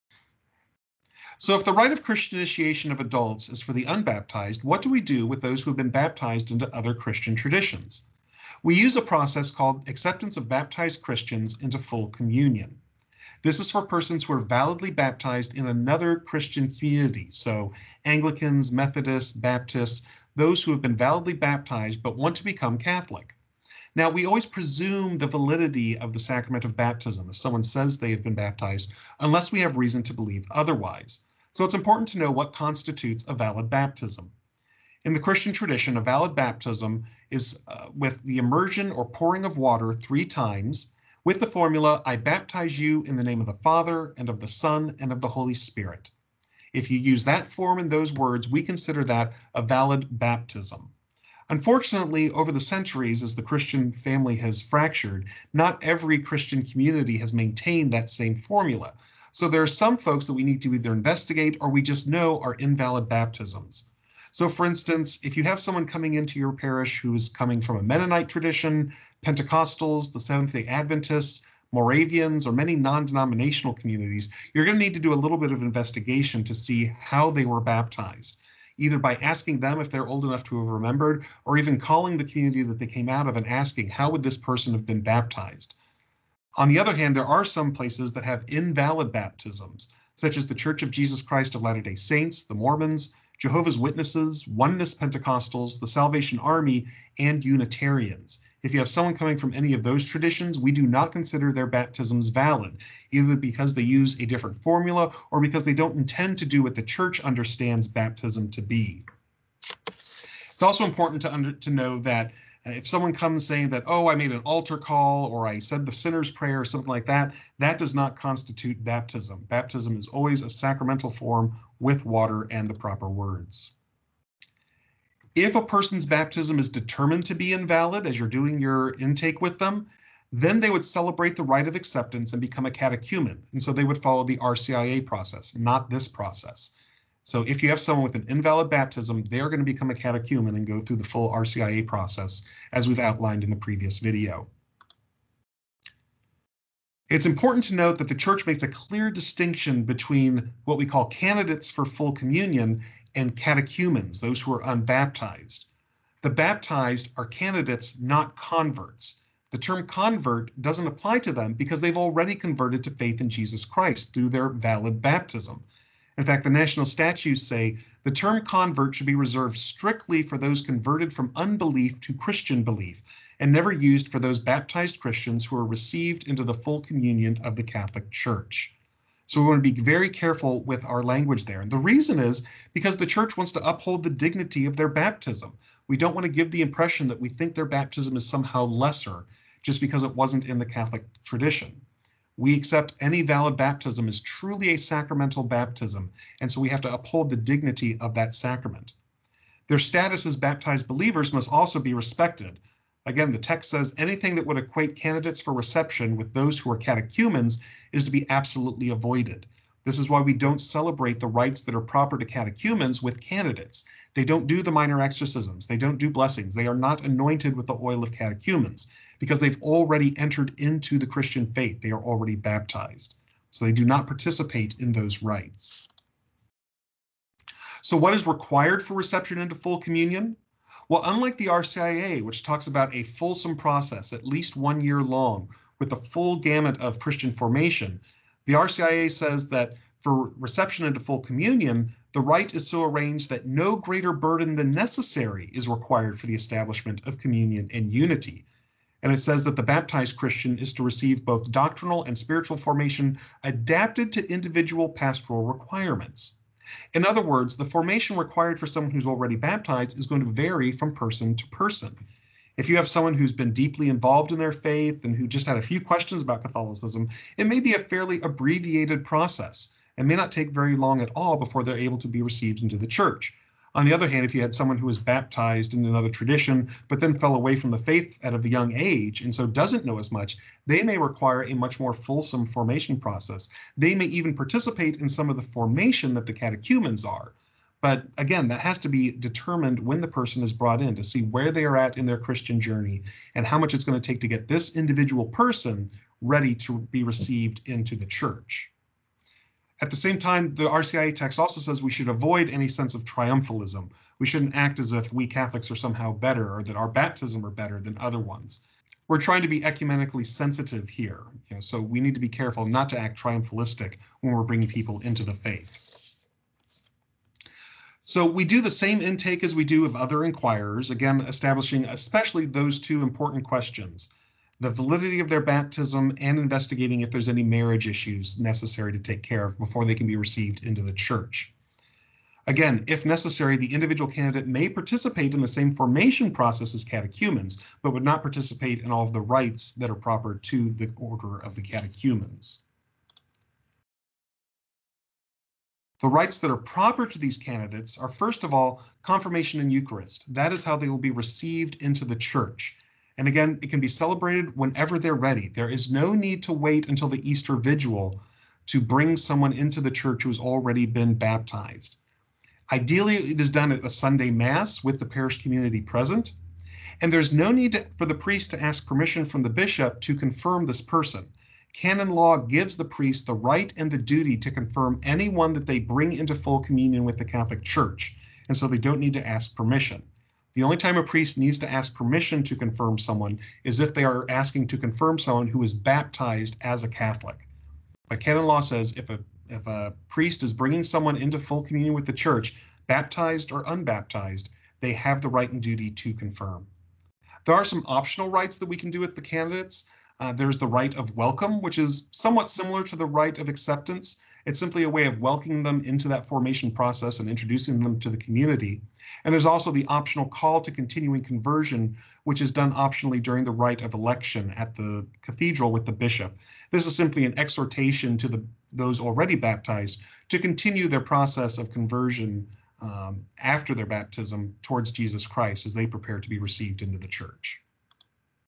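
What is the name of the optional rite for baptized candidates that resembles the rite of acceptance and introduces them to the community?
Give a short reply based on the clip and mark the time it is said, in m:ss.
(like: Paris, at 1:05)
rite of welcome, at 6:40.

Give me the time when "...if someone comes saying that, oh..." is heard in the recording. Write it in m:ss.
1:52.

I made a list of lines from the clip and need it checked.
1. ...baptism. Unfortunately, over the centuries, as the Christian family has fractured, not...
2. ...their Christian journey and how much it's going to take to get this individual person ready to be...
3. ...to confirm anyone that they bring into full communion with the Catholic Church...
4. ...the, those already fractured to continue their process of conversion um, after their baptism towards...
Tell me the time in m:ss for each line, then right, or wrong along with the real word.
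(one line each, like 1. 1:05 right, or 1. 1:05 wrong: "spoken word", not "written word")
1. 0:50 right
2. 4:52 right
3. 6:14 right
4. 6:58 wrong: "baptized", not "fractured".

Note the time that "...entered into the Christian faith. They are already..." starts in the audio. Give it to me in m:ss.
3:40.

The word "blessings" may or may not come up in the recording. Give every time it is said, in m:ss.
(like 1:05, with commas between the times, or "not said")
3:36.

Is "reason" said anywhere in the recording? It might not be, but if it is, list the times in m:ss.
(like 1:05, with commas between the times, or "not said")
0:29, 3:01.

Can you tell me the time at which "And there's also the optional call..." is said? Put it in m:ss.
6:49.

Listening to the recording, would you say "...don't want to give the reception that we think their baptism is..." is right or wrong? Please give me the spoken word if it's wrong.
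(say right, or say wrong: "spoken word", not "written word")
wrong: "impression", not "reception".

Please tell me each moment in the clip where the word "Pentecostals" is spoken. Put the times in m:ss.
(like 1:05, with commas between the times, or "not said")
1:09, 1:34.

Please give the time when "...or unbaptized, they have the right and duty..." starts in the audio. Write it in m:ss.
6:33.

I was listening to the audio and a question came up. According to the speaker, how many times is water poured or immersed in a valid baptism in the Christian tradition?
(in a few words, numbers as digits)
3.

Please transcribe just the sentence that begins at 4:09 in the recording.
And it says that the baptized Christian is to receive both doctrinal and spiritual formation adapted to individual pastoral requirements.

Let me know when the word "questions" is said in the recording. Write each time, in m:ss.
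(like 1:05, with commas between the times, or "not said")
4:25, 5:23.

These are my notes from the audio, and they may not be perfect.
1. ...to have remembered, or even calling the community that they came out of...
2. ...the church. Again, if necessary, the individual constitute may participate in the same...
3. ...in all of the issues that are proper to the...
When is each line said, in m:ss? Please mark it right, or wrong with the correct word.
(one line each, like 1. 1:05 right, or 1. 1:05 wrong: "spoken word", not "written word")
1. 1:20 right
2. 5:30 wrong: "candidate", not "constitute"
3. 5:38 wrong: "rites", not "issues".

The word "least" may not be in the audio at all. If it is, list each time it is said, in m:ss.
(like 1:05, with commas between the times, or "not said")
3:54.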